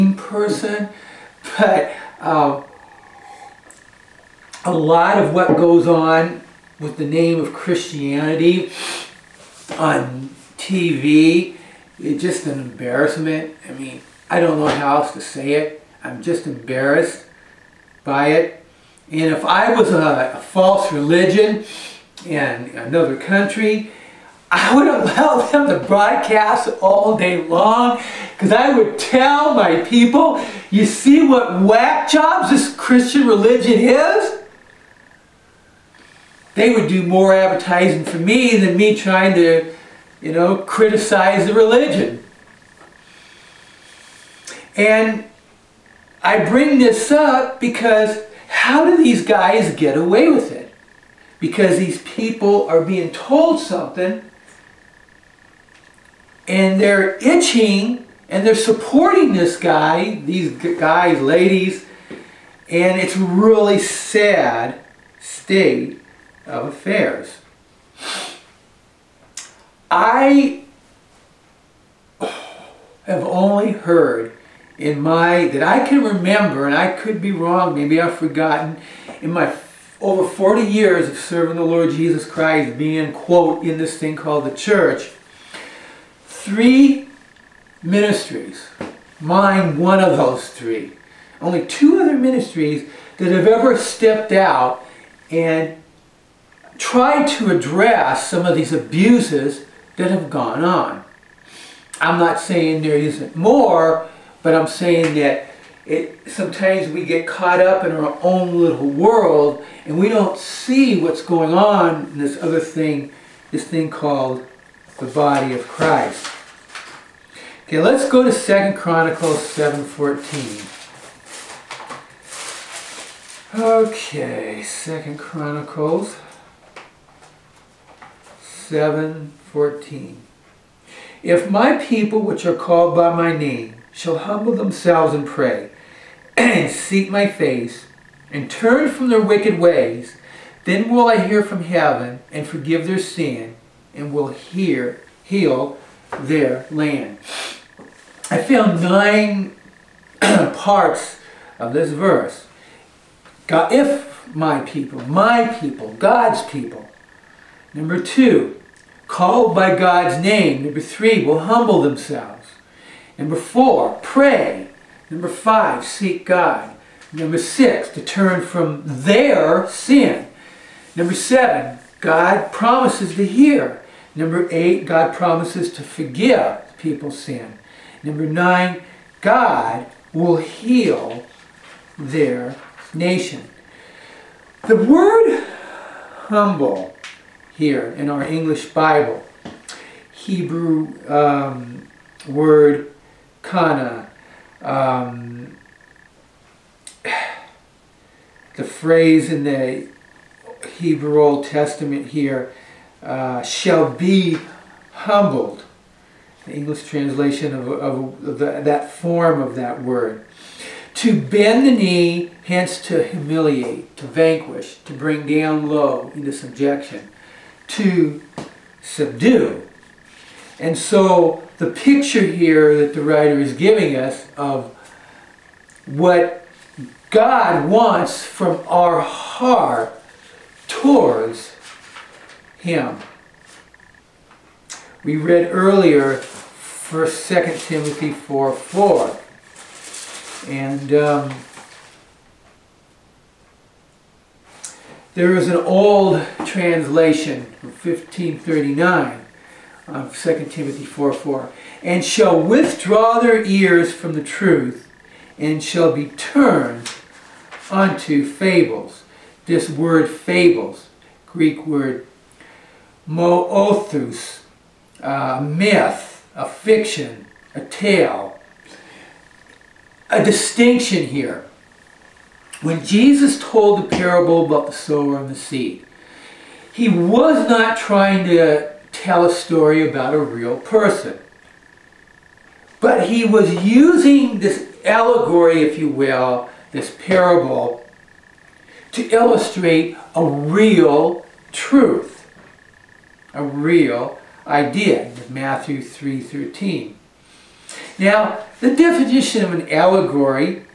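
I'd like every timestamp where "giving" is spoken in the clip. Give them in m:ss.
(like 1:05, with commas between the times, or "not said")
3:43.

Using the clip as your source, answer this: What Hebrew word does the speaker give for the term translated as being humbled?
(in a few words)
kana.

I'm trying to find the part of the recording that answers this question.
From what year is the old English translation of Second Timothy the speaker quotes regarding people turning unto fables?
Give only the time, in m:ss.
4:07.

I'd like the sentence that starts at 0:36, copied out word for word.
they would do more advertising for me than me trying to, you know, criticize the religion.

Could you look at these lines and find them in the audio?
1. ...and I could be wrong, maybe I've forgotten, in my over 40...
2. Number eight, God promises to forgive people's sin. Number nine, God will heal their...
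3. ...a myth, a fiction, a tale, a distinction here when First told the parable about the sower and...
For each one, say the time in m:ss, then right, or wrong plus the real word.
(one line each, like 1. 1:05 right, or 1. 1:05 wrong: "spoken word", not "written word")
1. 1:16 right
2. 2:54 right
3. 4:25 wrong: "Jesus", not "First".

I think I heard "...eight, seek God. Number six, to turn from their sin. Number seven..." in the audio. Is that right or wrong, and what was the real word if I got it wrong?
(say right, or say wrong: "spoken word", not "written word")
wrong: "five", not "eight".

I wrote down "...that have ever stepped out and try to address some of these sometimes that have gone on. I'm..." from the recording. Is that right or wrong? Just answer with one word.
wrong.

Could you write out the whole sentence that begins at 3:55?
We read earlier First, Second Timothy 4 4.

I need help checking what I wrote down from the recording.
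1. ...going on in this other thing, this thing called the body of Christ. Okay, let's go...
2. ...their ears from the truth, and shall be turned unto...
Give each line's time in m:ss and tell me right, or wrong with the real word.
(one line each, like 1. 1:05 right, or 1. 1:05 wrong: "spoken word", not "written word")
1. 1:51 right
2. 4:13 right.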